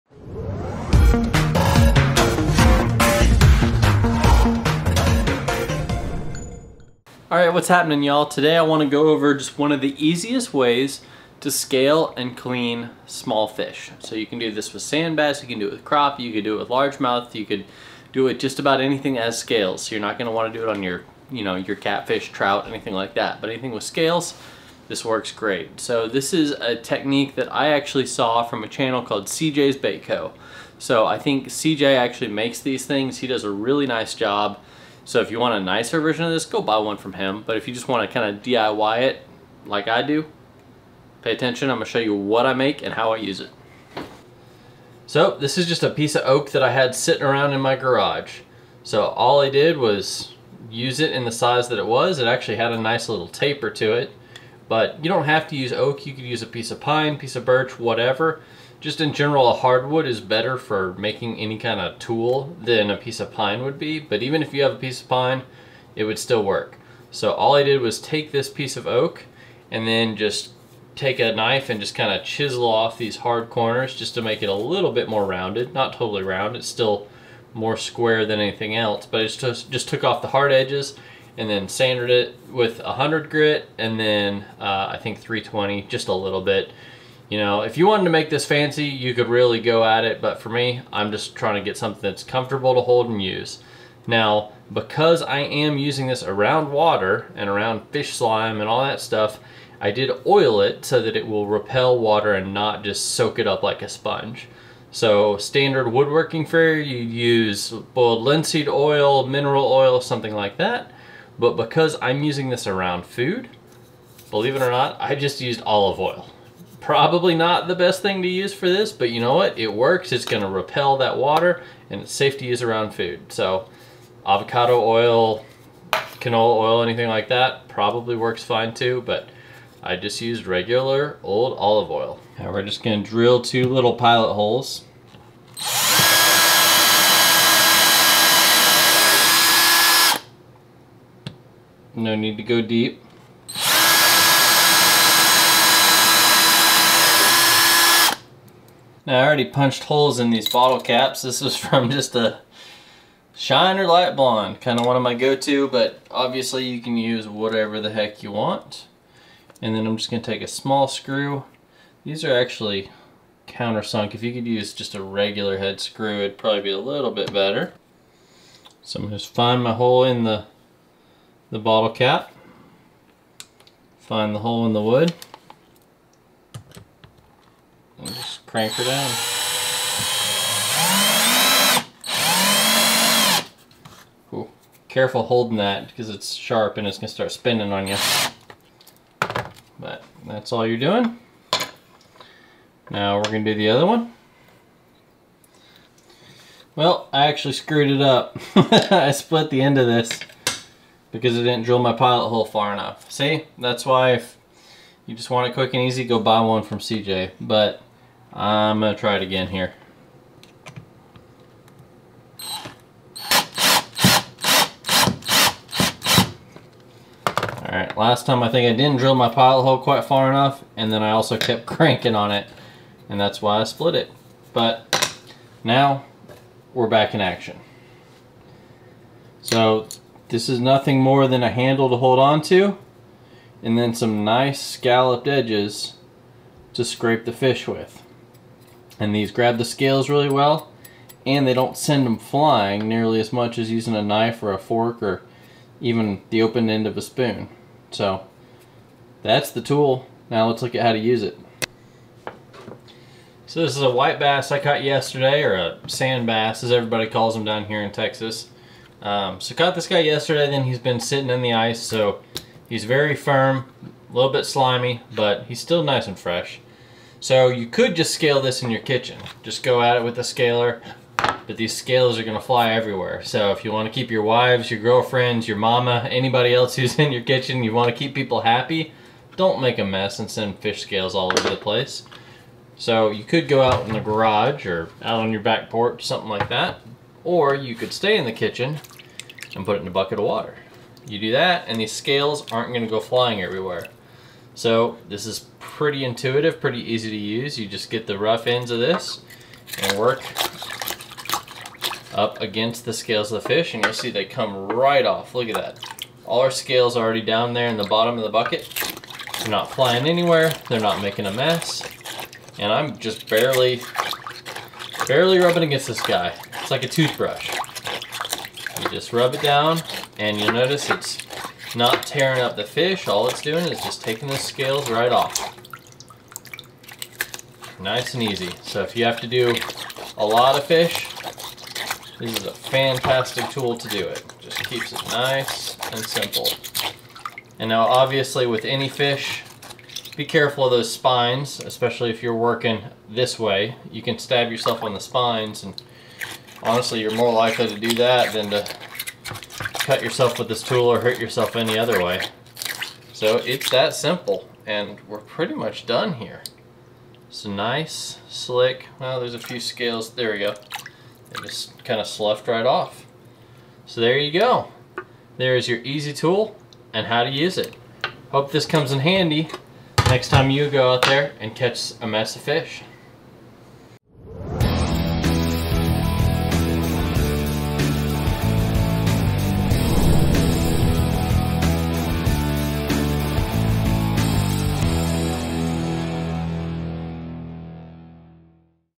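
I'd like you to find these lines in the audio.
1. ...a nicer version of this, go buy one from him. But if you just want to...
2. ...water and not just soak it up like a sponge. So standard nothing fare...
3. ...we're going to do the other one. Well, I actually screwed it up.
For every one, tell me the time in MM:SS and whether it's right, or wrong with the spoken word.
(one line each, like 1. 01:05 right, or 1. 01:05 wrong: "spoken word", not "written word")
1. 00:35 right
2. 01:41 wrong: "woodworking", not "nothing"
3. 03:13 right.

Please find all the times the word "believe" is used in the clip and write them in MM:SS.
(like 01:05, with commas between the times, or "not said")
01:54.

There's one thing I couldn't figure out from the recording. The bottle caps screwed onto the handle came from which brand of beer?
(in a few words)
Shiner Light Blonde.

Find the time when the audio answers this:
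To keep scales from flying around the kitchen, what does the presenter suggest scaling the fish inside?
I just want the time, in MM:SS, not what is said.
04:49.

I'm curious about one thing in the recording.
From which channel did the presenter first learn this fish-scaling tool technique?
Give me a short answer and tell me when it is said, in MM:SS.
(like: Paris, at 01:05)
CJ's Bait Co., at 00:29.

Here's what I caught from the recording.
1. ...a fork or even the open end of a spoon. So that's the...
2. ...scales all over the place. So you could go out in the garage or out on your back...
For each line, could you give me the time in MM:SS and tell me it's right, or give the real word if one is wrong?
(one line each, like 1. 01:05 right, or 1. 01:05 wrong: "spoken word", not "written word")
1. 04:04 right
2. 04:40 right.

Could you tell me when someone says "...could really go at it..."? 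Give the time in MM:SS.
01:29.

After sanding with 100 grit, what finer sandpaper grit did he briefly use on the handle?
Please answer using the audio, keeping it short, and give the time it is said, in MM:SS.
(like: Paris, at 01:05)
320, at 01:25.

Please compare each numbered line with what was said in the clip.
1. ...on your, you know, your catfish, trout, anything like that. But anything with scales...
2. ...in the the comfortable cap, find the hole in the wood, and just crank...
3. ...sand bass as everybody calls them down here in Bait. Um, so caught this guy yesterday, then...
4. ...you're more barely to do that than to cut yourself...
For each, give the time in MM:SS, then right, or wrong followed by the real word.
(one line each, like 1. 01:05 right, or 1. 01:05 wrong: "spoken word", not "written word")
1. 00:20 right
2. 02:50 wrong: "bottle", not "comfortable"
3. 04:15 wrong: "Texas", not "Bait"
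4. 05:47 wrong: "likely", not "barely".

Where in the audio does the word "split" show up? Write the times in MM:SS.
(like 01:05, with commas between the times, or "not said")
03:19, 03:43.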